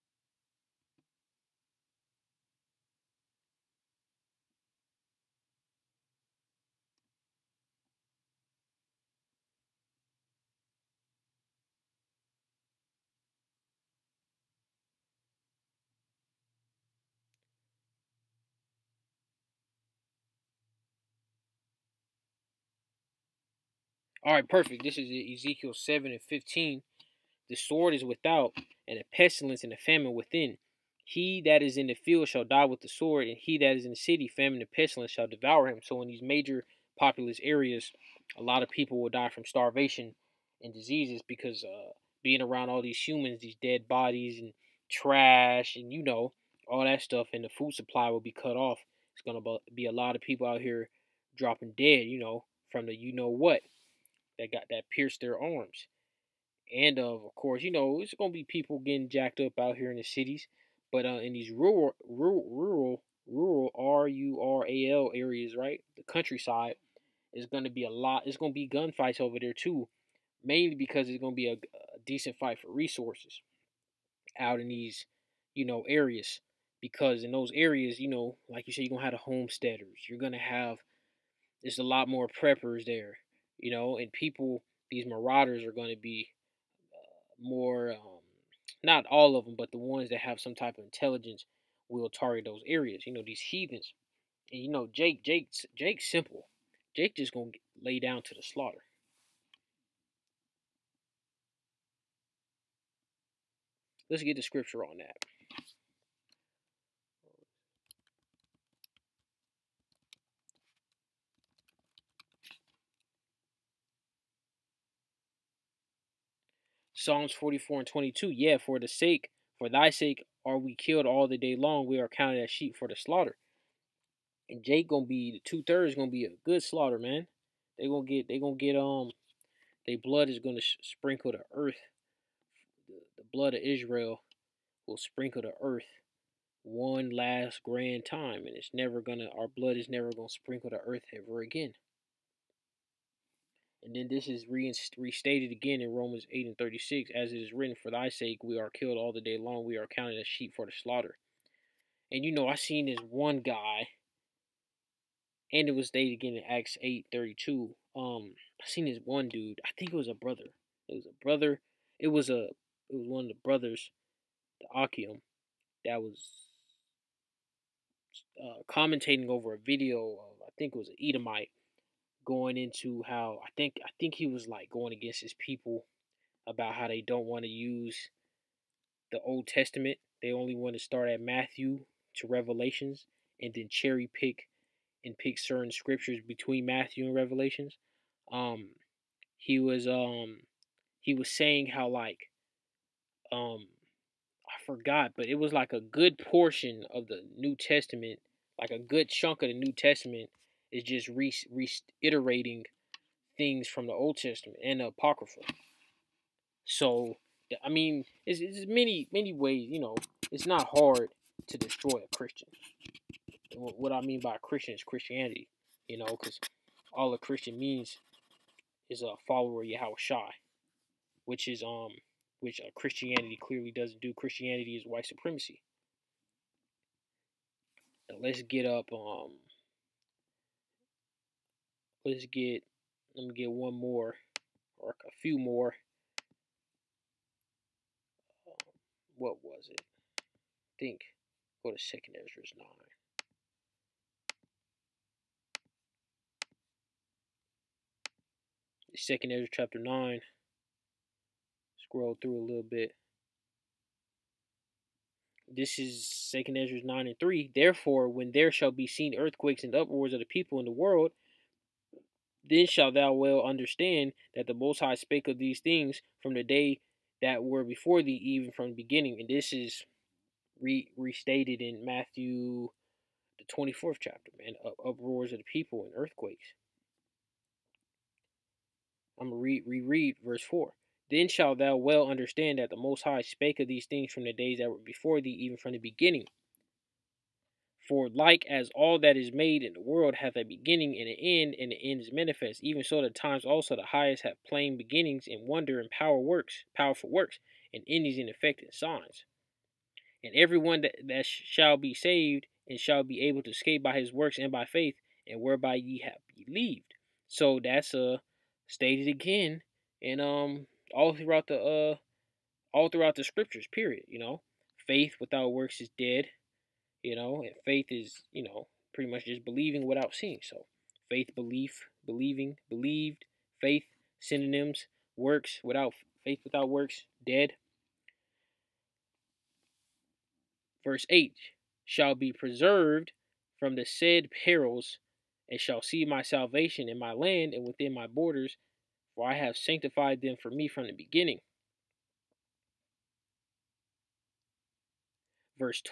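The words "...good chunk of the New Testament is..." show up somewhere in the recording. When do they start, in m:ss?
3:18.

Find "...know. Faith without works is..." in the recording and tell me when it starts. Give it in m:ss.
5:14.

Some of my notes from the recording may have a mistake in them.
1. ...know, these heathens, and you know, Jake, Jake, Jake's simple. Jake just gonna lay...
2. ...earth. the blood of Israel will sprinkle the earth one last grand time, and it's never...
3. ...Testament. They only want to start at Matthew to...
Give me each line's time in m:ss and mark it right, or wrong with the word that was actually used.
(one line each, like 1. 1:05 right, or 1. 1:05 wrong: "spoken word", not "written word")
1. 1:33 right
2. 2:11 right
3. 2:59 right.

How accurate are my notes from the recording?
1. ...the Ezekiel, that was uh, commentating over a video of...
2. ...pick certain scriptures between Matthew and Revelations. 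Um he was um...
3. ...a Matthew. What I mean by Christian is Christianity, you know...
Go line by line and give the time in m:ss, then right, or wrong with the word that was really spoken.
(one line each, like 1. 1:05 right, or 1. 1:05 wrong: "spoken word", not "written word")
1. 2:44 wrong: "Achium", not "Ezekiel"
2. 3:05 right
3. 3:32 wrong: "Christian", not "Matthew".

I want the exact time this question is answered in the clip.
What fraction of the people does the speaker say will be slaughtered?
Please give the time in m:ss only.
2:05.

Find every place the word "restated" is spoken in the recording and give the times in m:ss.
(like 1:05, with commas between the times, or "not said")
2:24, 4:30.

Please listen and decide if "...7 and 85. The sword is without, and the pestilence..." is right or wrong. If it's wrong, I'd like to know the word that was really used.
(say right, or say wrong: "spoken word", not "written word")
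wrong: "15", not "85".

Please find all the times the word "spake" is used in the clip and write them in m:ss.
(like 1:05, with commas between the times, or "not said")
4:24, 4:43.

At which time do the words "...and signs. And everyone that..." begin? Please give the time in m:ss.
4:58.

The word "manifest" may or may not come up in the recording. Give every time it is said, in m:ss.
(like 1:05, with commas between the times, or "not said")
4:52.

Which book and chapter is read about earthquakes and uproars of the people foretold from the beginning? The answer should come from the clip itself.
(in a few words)
2 Esdras 9.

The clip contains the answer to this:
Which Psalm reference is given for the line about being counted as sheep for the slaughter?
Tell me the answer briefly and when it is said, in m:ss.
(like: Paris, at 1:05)
Psalms 44:22, at 1:57.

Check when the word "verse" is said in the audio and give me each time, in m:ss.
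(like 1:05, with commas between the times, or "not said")
4:40, 5:30.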